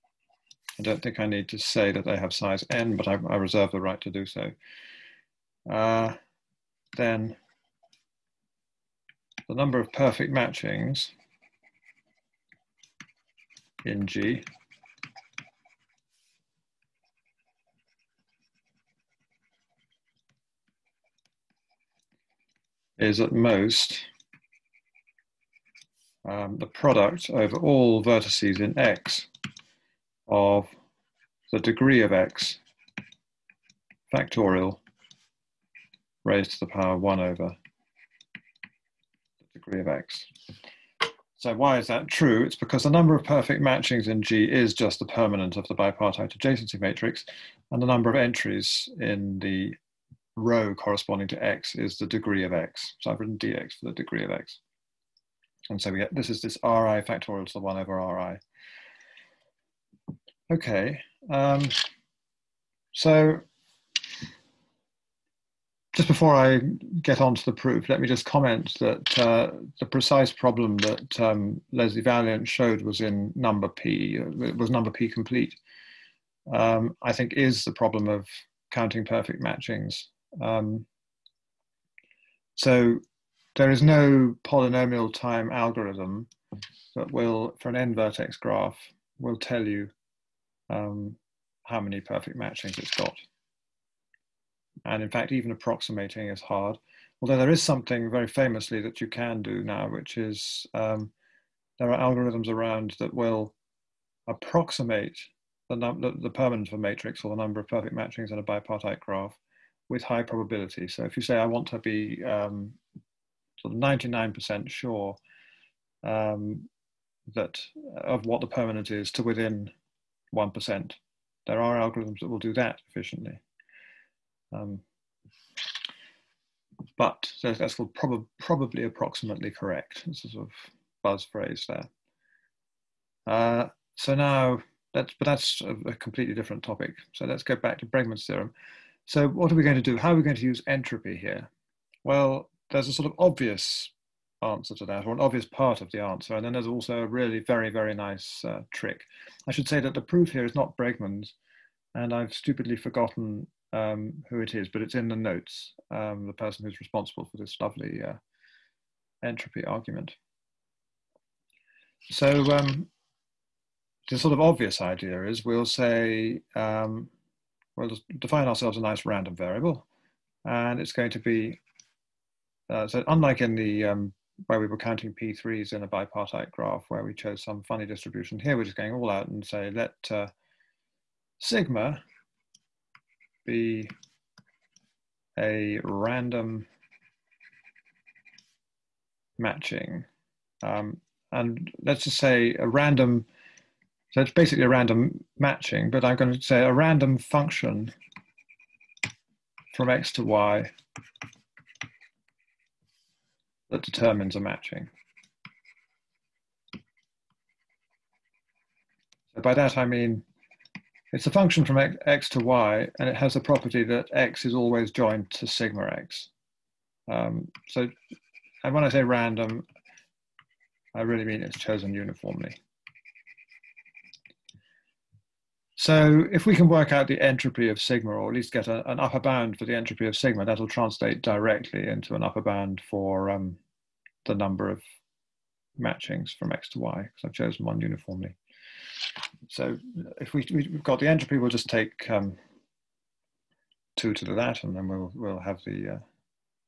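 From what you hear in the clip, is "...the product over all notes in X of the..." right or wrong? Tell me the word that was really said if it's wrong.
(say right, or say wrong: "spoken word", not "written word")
wrong: "vertices", not "notes".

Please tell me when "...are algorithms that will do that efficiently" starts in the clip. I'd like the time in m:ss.
2:01.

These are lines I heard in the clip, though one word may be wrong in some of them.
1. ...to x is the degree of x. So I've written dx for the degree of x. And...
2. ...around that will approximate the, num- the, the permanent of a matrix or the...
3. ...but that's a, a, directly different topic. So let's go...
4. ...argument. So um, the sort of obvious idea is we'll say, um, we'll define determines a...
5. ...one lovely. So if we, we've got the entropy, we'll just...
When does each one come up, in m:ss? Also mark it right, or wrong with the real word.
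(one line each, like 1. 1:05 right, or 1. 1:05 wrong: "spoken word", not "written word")
1. 0:51 right
2. 1:42 right
3. 2:15 wrong: "completely", not "directly"
4. 2:39 wrong: "ourselves", not "determines"
5. 3:57 wrong: "uniformly", not "lovely".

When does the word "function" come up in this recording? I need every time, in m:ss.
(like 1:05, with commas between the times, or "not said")
3:17, 3:31.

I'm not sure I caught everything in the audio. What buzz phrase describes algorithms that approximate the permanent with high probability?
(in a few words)
probably approximately correct.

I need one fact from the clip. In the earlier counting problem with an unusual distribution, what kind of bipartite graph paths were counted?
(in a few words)
P3s.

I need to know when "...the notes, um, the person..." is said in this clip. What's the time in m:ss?
2:35.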